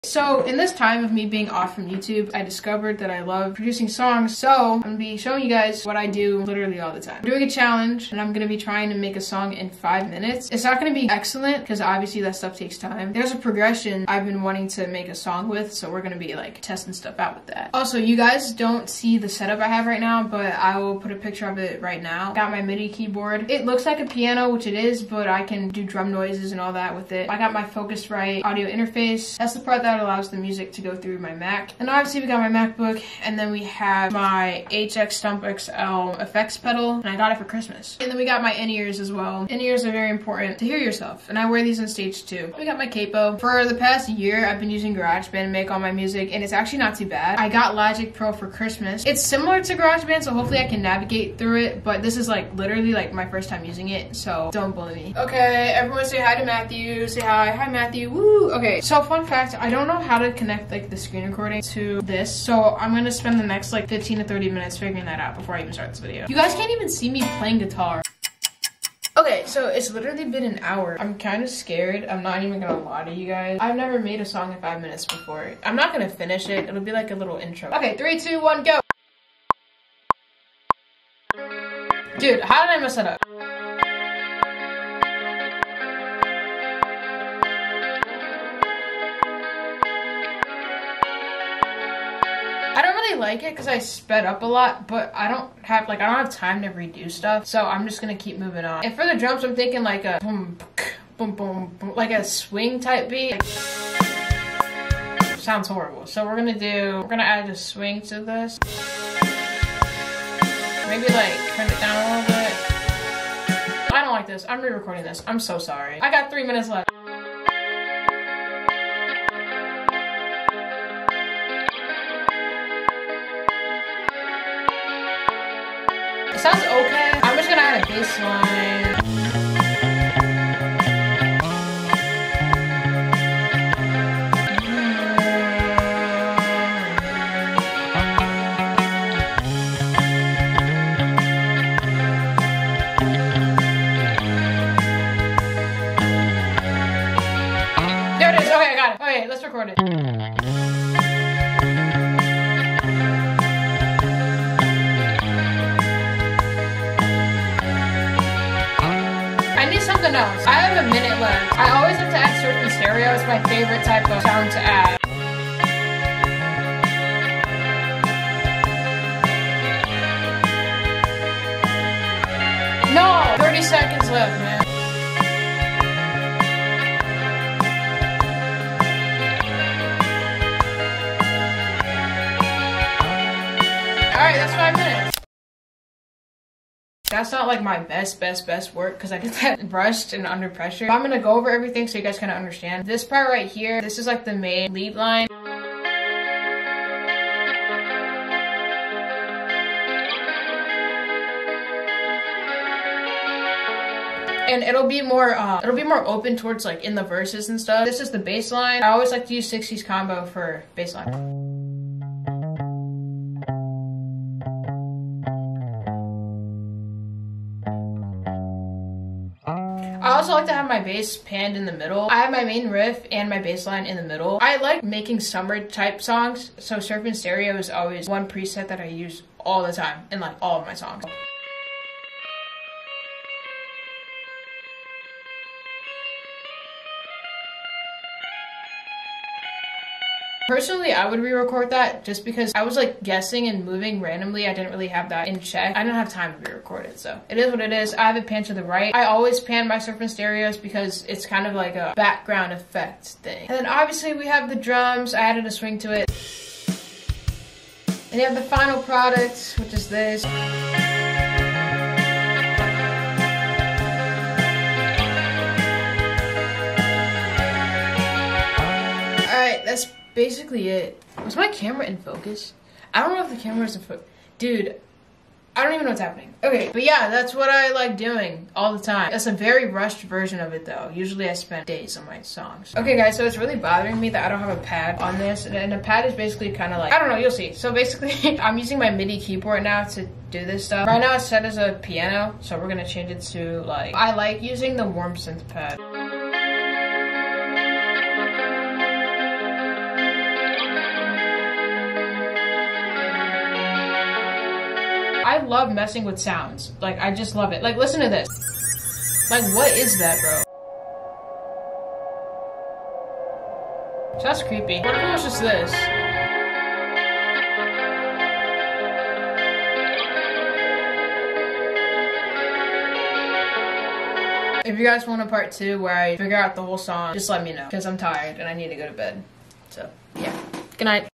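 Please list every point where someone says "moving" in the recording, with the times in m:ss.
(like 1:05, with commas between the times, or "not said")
1:38, 4:03.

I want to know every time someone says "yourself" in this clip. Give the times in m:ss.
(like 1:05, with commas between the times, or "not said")
0:40.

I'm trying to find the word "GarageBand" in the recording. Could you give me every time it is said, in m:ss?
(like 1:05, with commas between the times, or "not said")
0:44, 0:49.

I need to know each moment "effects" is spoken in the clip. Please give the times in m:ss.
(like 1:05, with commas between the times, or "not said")
0:36, 4:12.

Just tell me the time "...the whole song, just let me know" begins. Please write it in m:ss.
5:26.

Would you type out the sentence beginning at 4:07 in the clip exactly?
I have it panned to the right.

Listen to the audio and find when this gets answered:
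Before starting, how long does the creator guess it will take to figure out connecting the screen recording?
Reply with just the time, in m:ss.
1:03.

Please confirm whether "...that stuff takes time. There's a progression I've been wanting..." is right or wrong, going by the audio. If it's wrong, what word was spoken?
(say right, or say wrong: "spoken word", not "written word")
right.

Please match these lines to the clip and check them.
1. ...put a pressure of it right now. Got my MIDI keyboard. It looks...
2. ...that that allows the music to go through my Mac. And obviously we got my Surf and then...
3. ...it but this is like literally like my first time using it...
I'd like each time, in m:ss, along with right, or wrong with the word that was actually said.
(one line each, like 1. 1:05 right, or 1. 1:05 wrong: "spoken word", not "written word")
1. 0:20 wrong: "picture", not "pressure"
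2. 0:29 wrong: "MacBook", not "Surf"
3. 0:51 right.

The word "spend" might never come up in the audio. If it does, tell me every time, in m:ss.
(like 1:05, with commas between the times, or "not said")
1:03, 4:41.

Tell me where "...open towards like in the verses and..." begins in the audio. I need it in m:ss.
3:26.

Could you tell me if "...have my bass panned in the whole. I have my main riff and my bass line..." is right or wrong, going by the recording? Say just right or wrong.
wrong.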